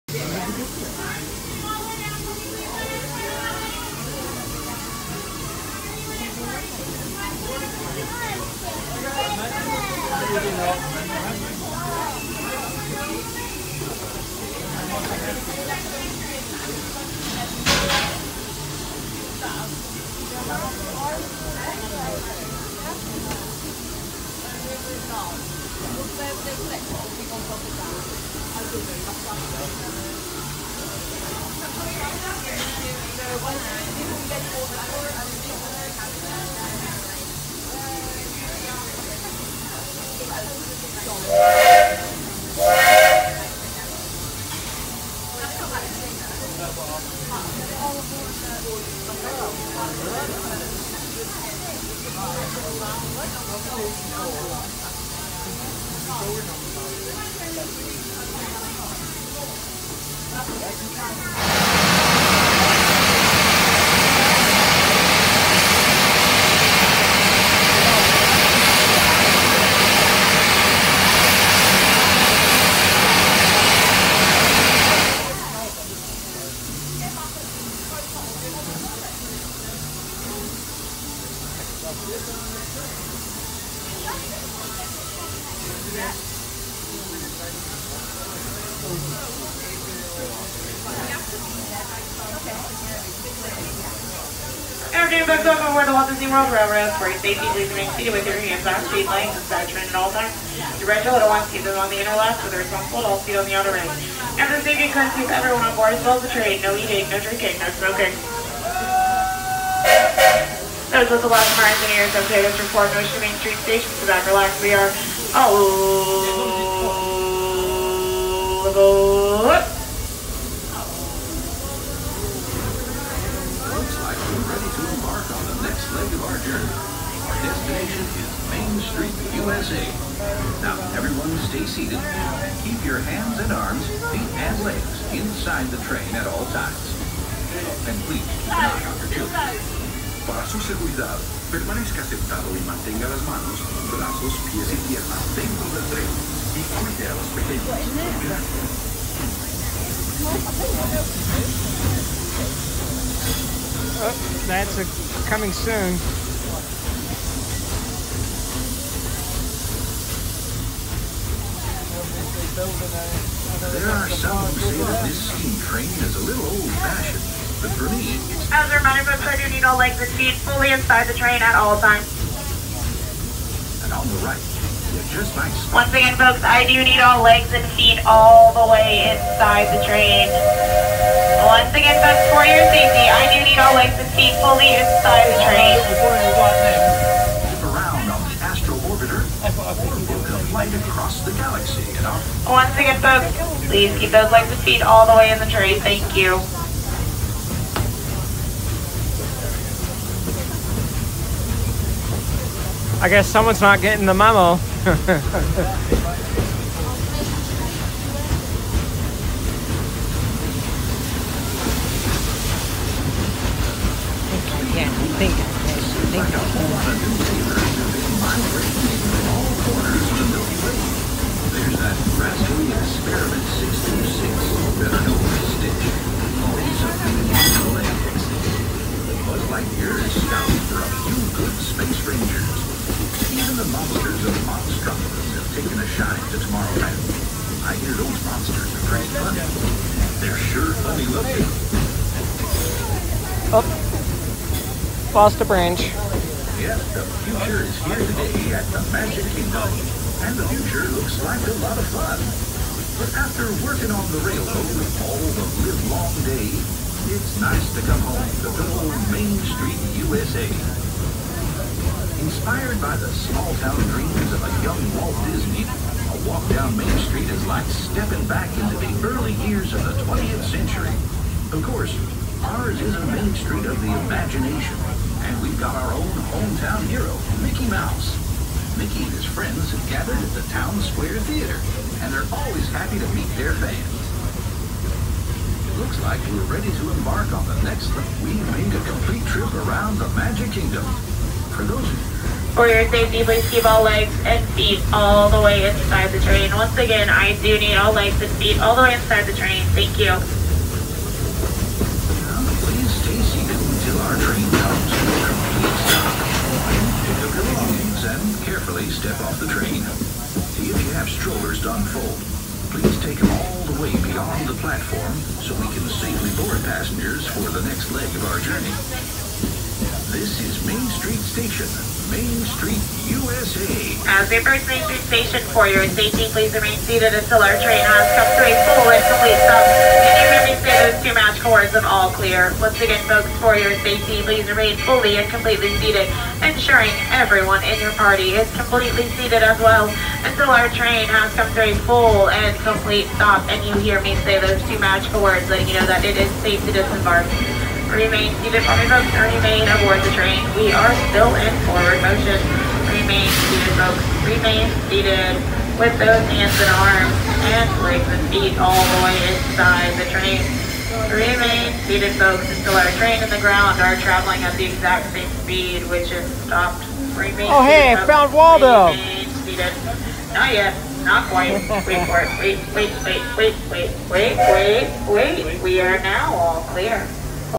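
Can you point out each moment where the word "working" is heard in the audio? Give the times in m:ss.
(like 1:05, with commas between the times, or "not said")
4:13.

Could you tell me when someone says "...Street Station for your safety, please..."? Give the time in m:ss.
5:24.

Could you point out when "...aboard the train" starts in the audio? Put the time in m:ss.
5:49.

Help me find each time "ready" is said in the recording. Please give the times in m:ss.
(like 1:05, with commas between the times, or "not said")
2:04, 4:46.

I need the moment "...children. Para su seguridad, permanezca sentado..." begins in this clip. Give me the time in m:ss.
2:19.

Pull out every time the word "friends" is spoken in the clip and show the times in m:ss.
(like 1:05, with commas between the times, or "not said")
4:39.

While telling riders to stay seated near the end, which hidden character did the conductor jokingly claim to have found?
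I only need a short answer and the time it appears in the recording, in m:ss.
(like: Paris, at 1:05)
Waldo, at 6:08.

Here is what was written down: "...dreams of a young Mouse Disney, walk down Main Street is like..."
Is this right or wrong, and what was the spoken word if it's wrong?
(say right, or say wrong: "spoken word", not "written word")
wrong: "Walt", not "Mouse".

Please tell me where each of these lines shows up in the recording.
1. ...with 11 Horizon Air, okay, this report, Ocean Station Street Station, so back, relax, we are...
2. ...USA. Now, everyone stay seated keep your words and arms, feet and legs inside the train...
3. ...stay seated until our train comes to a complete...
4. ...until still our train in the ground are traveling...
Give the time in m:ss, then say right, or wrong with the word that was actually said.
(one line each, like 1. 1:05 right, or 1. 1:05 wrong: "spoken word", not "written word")
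1. 1:51 wrong: "Main", not "Station"
2. 2:09 wrong: "hands", not "words"
3. 5:03 right
4. 6:02 right.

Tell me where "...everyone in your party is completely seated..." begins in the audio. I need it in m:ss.
5:37.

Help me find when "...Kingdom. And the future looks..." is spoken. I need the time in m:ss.
4:09.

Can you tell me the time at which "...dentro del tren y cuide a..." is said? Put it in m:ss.
2:25.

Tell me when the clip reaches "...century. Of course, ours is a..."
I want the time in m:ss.
4:30.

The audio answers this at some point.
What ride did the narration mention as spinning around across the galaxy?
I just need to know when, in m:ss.
3:08.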